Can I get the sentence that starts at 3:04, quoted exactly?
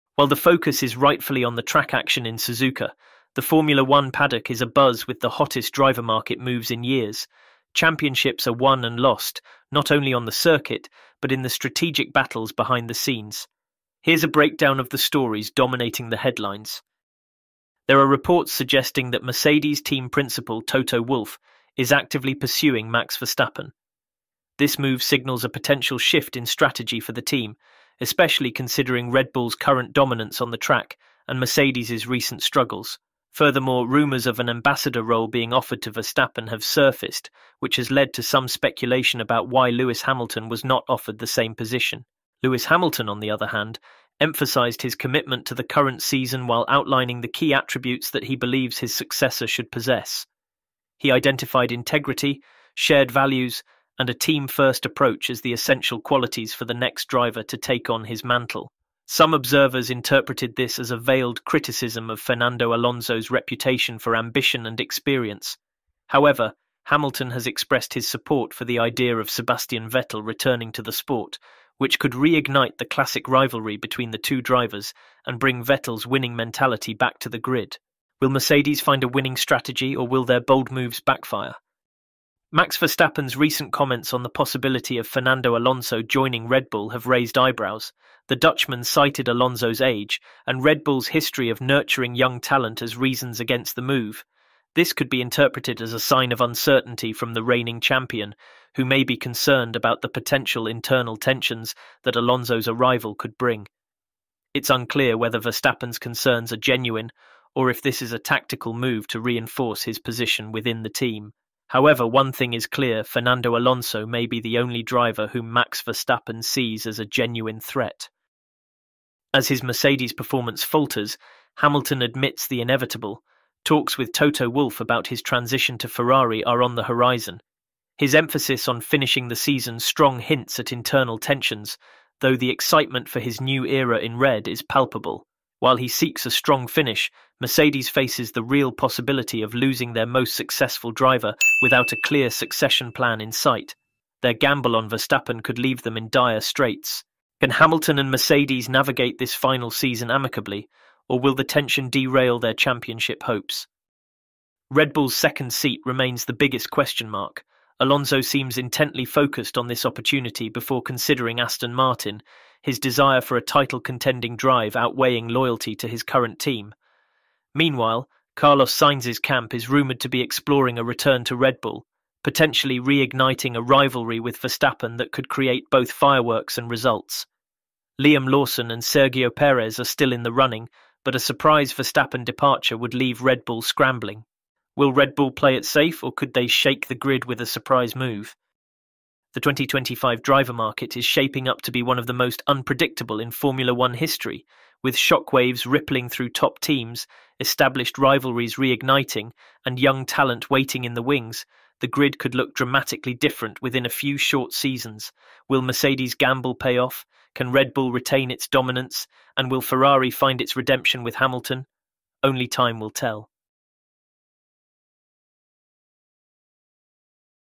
Will Red Bull play it safe, or could they shake the grid with a surprise move?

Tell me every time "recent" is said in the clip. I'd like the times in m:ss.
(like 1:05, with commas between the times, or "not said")
0:32, 1:23.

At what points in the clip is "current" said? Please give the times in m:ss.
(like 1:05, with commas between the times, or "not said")
0:29, 0:45, 2:46.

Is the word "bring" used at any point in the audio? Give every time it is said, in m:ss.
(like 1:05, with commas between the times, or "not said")
1:15, 1:43.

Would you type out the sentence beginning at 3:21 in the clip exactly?
The grid could look dramatically different within a few short seasons.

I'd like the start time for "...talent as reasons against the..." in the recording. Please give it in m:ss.
1:32.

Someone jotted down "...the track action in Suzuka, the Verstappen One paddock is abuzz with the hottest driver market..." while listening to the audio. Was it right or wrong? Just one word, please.
wrong.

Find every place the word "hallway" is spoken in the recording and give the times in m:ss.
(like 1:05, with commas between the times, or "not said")
not said.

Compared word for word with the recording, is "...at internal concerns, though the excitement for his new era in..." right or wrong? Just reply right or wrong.
wrong.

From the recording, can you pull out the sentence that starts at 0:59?
Some observers interpreted this as a veiled criticism of Fernando Alonso's reputation for ambition and experience.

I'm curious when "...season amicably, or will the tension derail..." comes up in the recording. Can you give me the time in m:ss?
2:29.